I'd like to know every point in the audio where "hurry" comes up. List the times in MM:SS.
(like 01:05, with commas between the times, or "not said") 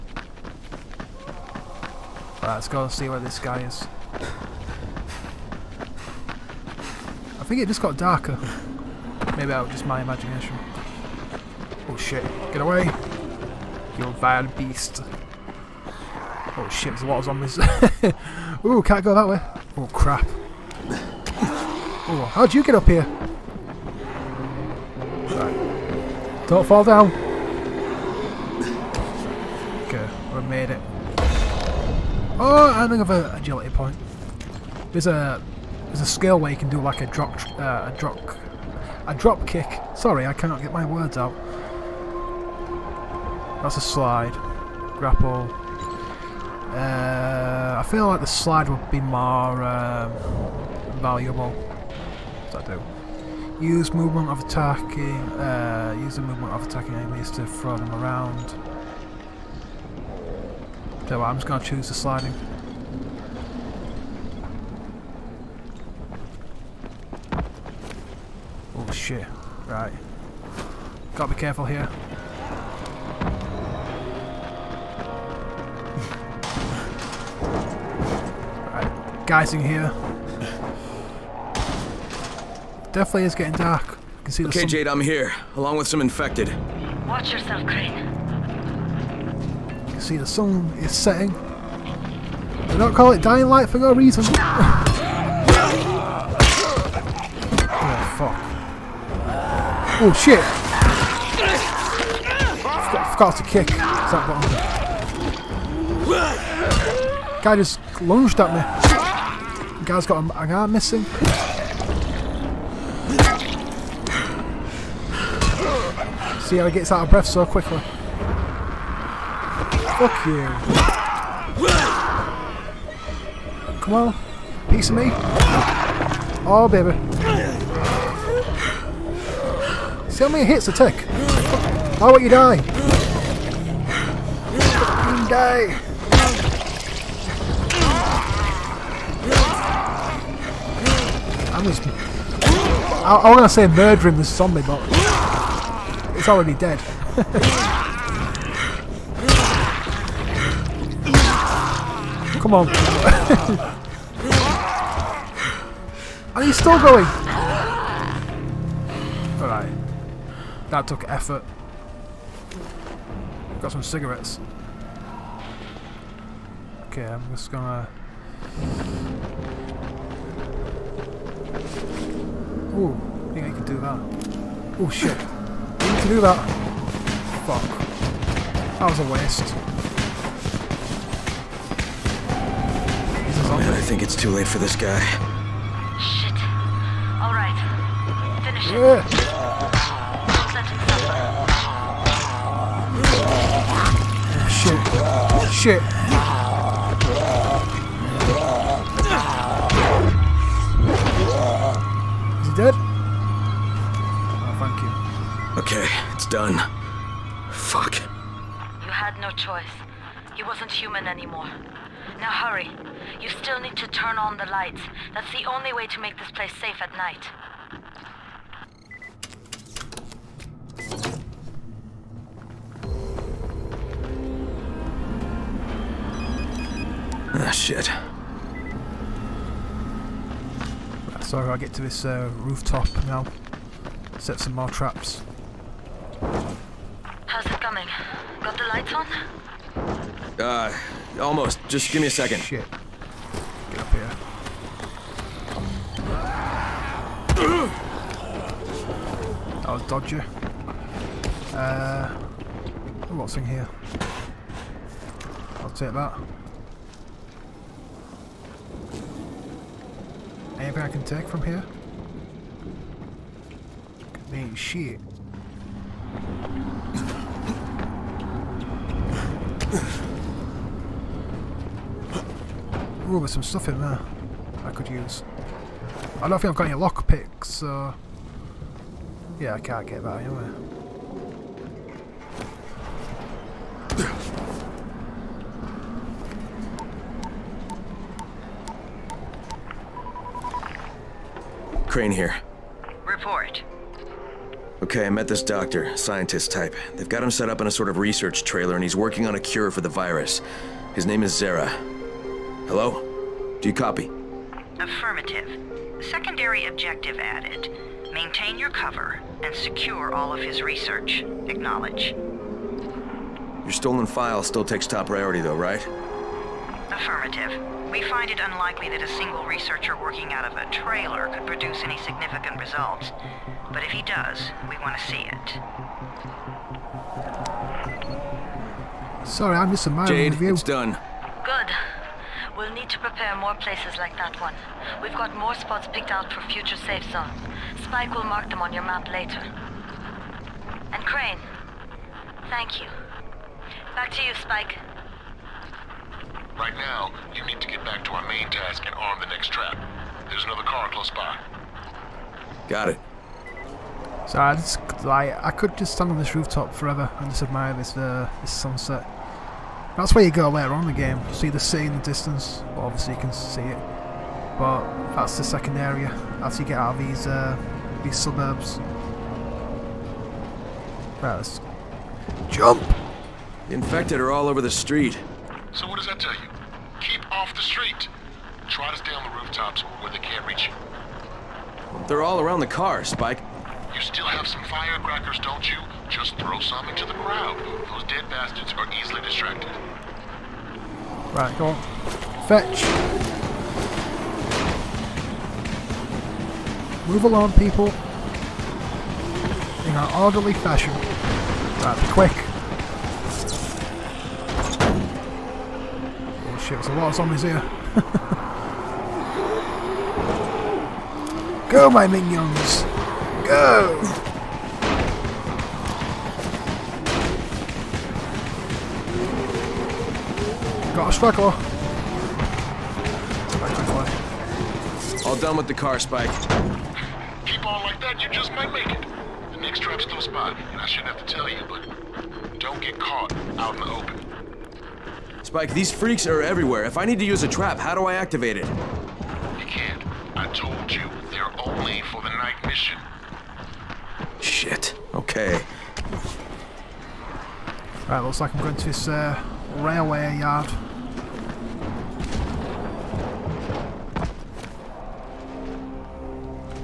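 03:32.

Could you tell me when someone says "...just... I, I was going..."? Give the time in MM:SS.
02:21.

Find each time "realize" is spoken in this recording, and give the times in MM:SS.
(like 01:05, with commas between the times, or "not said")
not said.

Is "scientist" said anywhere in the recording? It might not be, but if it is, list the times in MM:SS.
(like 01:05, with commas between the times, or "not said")
04:55.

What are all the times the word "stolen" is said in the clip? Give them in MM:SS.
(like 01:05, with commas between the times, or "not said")
05:13.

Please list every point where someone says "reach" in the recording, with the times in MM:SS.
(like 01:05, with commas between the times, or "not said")
06:20.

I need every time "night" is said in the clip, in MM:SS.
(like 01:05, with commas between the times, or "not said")
03:36, 07:22.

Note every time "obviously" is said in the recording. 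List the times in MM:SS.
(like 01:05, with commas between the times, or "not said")
06:02.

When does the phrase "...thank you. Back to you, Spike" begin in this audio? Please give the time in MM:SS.
05:42.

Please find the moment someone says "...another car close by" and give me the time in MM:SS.
05:50.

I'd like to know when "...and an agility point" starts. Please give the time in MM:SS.
00:32.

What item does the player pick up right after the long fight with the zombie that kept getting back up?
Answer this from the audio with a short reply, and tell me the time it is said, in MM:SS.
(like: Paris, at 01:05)
Cigarettes, at 02:43.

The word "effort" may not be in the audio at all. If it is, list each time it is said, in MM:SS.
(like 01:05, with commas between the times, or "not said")
02:41.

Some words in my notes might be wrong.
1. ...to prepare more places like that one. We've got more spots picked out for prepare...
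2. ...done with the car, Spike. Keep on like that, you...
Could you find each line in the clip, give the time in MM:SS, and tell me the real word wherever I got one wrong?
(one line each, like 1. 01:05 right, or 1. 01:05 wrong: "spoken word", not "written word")
1. 05:32 wrong: "future", not "prepare"
2. 07:05 right.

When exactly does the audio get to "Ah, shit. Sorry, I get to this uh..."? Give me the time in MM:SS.
03:47.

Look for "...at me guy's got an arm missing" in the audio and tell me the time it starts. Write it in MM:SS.
01:48.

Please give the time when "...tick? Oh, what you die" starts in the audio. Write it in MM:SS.
02:10.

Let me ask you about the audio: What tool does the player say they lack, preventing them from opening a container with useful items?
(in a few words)
Lockpicks.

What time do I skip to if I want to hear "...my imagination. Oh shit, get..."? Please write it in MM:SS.
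00:09.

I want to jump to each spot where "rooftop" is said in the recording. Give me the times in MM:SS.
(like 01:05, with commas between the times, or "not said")
03:52, 05:56, 06:19.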